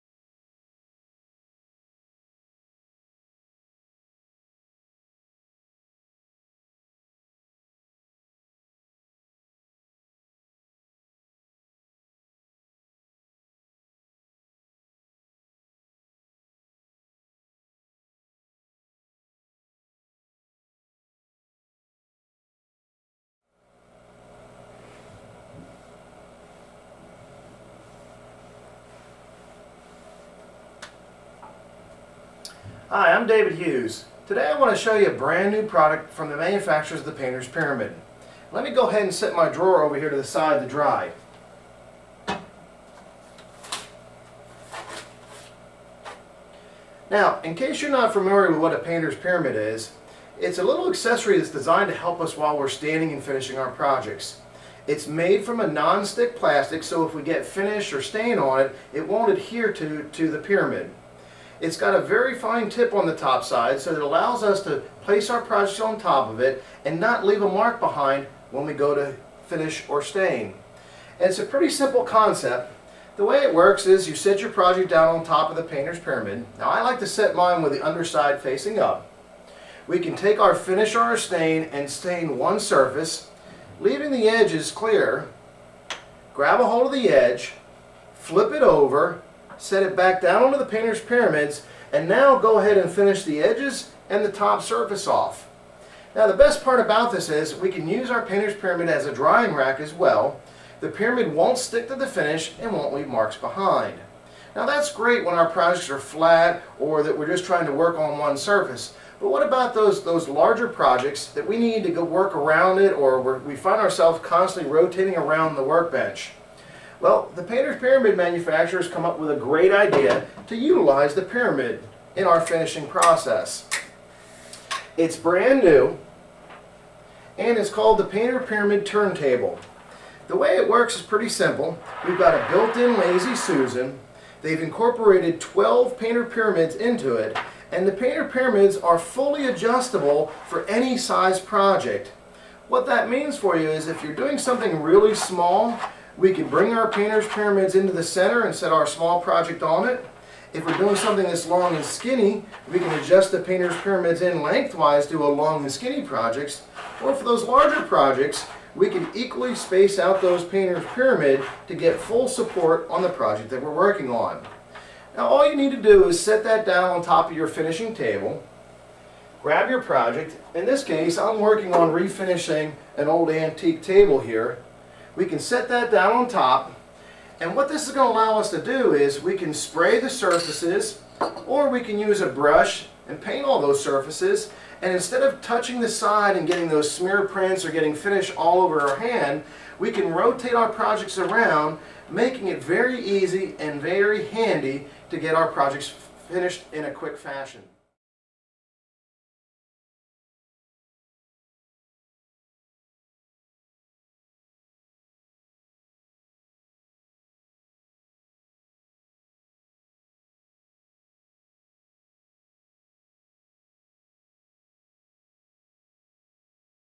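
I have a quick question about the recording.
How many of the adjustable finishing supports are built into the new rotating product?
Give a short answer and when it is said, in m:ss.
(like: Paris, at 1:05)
12, at 2:15.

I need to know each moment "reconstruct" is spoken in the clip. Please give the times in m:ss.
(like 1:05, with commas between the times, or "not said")
not said.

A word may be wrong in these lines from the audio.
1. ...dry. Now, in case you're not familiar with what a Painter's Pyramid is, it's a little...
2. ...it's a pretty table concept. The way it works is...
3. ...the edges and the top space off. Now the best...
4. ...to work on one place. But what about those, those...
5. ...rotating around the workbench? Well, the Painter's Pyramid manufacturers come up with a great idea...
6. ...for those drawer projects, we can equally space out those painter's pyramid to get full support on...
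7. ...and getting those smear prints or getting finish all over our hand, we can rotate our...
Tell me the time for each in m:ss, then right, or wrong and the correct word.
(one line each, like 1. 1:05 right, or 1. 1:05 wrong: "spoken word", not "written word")
1. 0:40 right
2. 1:11 wrong: "simple", not "table"
3. 1:33 wrong: "surface", not "space"
4. 1:47 wrong: "surface", not "place"
5. 1:54 right
6. 2:37 wrong: "larger", not "drawer"
7. 3:06 right.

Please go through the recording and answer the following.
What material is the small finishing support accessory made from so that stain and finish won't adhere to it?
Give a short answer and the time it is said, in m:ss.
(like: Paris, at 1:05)
non-stick plastic, at 0:55.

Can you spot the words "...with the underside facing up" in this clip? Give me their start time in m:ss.
1:17.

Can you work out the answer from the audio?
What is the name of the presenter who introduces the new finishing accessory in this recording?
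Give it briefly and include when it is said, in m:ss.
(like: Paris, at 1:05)
David Hughes, at 0:33.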